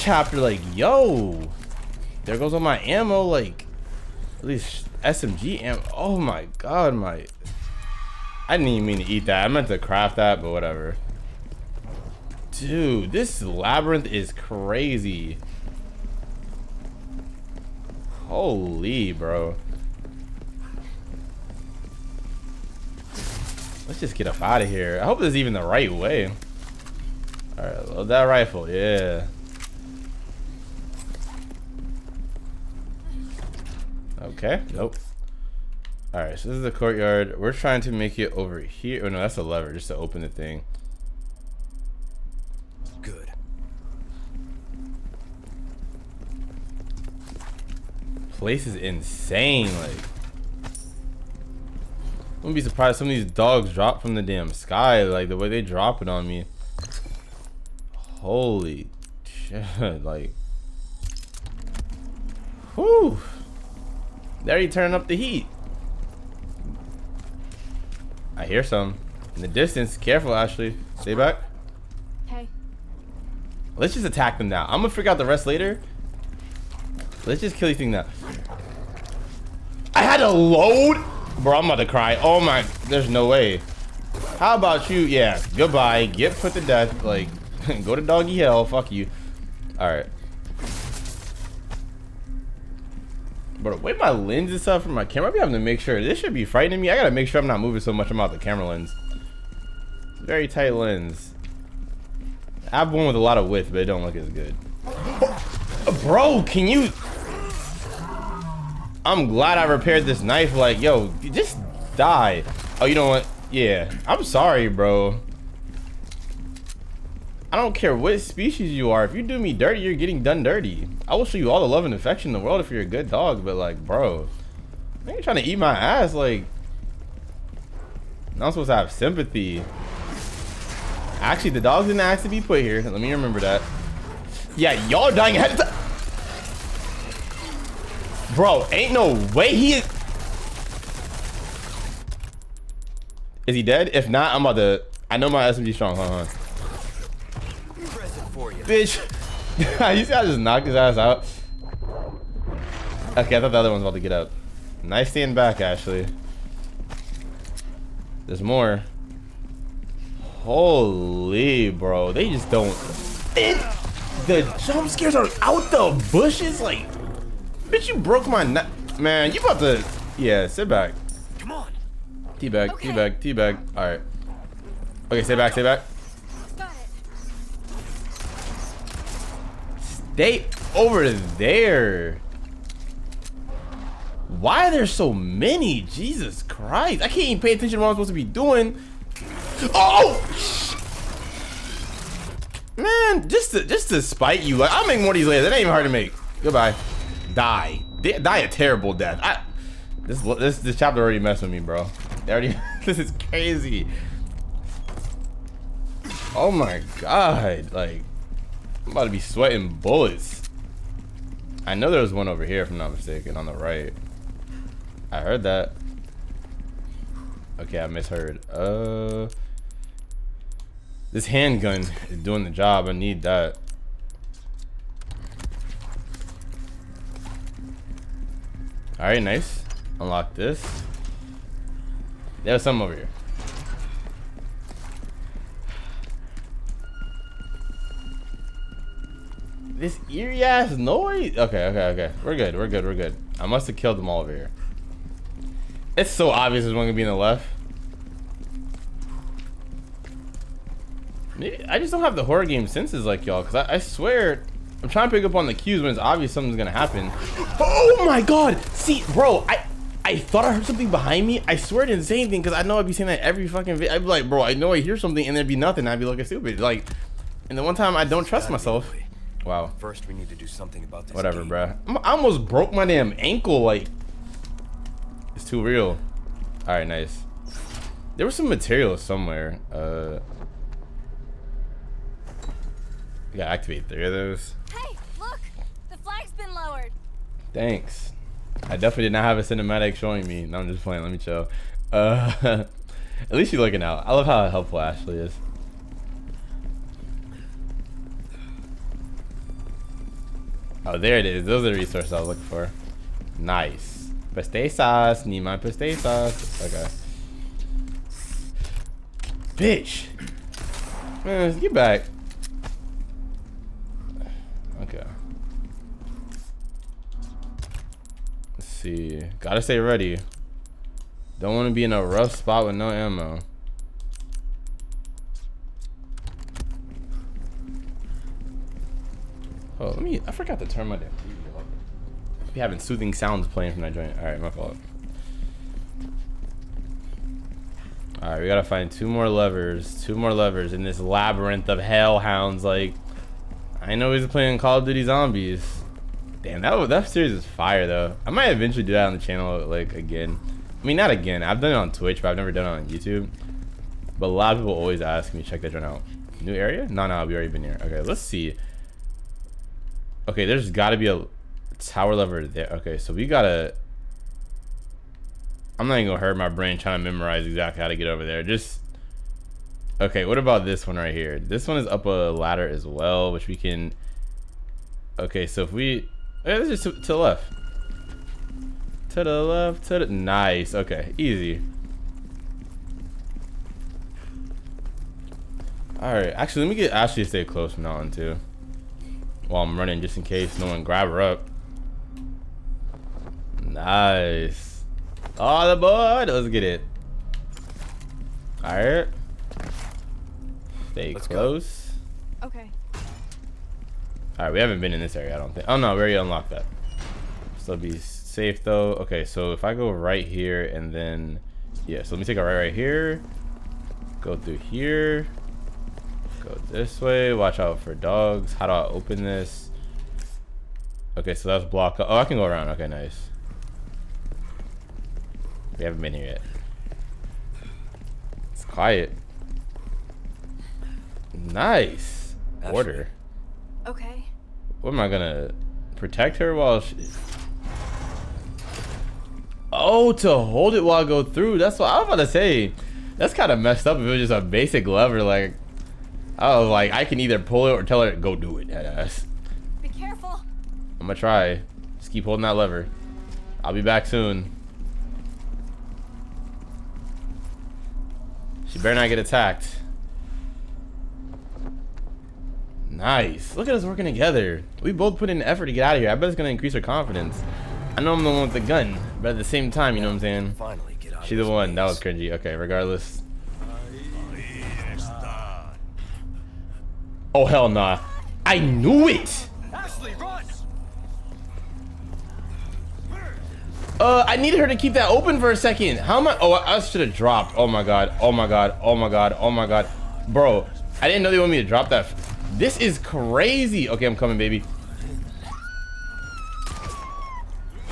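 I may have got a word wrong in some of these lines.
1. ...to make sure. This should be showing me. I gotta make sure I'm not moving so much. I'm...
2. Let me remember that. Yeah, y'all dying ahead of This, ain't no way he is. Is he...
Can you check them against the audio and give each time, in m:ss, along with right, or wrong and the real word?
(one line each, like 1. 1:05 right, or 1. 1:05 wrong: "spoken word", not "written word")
1. 1:35 wrong: "frightening", not "showing"
2. 2:12 wrong: "Bro", not "This".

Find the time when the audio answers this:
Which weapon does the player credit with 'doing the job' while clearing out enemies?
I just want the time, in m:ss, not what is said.
3:41.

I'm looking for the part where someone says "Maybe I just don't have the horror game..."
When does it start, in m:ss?
4:11.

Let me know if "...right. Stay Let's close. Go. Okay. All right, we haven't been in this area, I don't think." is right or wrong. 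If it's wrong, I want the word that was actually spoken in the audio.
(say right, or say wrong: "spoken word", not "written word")
right.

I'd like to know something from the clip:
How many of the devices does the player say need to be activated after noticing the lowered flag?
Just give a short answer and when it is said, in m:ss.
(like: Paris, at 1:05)
3, at 4:43.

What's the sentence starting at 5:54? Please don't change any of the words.
But a lot of people always ask me, check that joint out.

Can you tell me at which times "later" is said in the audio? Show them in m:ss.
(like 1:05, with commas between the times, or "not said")
1:15, 3:15.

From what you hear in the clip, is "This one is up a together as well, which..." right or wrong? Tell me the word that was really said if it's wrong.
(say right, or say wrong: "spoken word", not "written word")
wrong: "ladder", not "together".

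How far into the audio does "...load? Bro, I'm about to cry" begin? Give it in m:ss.
1:20.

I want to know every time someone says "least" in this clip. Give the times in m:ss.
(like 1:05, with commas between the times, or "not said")
0:04, 4:53.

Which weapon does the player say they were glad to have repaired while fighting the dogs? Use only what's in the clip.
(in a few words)
knife.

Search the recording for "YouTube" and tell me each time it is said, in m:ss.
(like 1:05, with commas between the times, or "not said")
5:52.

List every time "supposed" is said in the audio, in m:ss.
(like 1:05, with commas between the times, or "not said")
2:08, 3:07.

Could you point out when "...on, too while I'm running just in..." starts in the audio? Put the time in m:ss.
6:27.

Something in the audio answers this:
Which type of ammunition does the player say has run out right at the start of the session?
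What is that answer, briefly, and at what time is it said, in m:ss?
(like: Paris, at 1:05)
SMG ammo, at 0:05.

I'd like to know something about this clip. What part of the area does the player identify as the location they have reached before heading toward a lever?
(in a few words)
courtyard.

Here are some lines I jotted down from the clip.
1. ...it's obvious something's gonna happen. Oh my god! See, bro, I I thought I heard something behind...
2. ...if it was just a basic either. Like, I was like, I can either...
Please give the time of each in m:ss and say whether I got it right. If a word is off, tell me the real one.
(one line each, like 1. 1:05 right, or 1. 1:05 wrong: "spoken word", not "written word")
1. 4:15 right
2. 7:23 wrong: "lever", not "either".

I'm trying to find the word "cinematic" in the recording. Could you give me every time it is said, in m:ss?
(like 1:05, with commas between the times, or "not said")
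4:49.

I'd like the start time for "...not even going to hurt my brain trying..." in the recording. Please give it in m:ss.
6:05.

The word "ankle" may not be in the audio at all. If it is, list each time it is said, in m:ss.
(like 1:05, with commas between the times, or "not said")
4:33.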